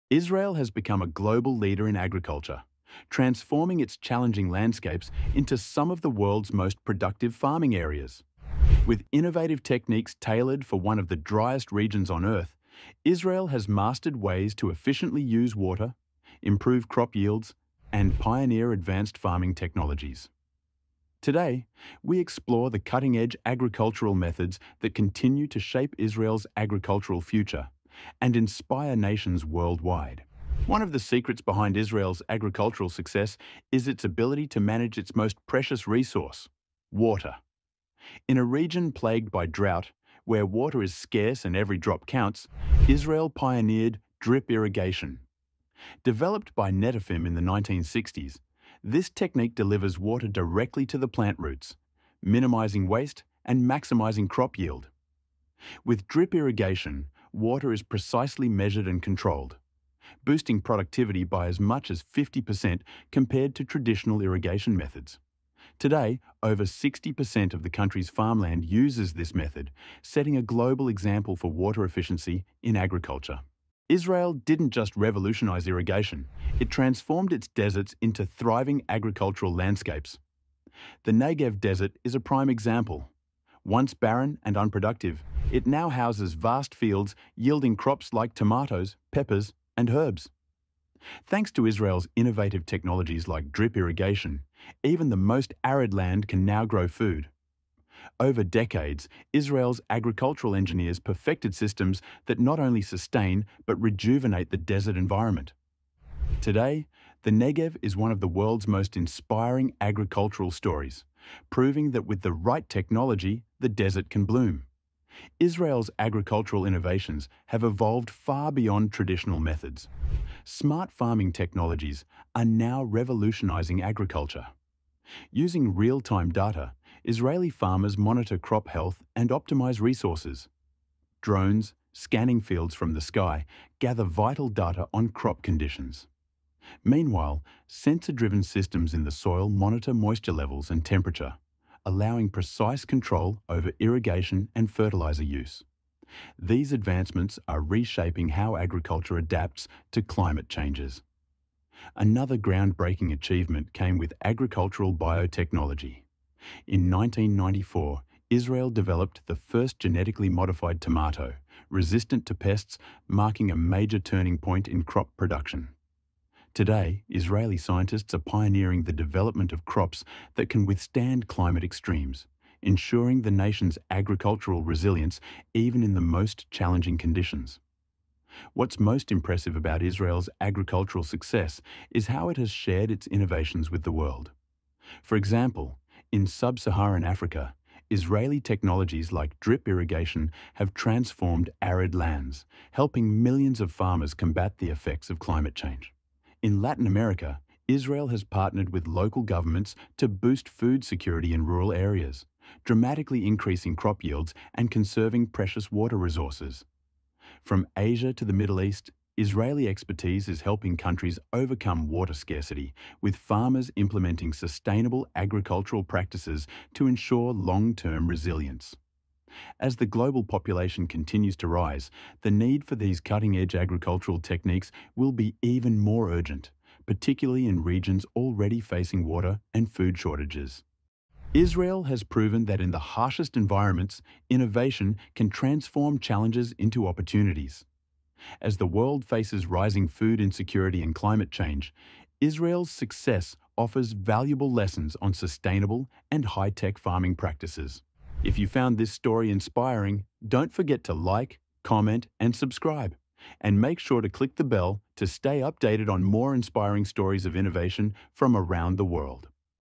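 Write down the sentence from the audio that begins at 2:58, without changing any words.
What's most impressive about Israel's agricultural success is how it has shared its innovations with the world.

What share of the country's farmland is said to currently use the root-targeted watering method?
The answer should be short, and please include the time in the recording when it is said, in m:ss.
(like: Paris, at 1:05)
over 60%, at 1:06.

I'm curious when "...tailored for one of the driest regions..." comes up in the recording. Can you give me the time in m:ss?
0:10.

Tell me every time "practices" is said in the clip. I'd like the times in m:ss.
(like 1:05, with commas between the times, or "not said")
3:35, 4:07.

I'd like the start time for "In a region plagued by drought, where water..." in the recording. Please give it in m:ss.
0:38.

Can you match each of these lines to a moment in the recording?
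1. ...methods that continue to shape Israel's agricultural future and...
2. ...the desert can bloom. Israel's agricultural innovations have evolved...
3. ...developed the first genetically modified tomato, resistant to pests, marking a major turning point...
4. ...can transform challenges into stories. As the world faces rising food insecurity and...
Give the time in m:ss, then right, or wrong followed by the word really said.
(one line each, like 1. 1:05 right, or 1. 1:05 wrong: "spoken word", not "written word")
1. 0:24 right
2. 1:53 right
3. 2:38 right
4. 3:55 wrong: "opportunities", not "stories".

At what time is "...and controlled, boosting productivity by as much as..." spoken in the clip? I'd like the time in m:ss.
0:58.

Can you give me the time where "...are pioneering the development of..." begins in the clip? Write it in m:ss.
2:48.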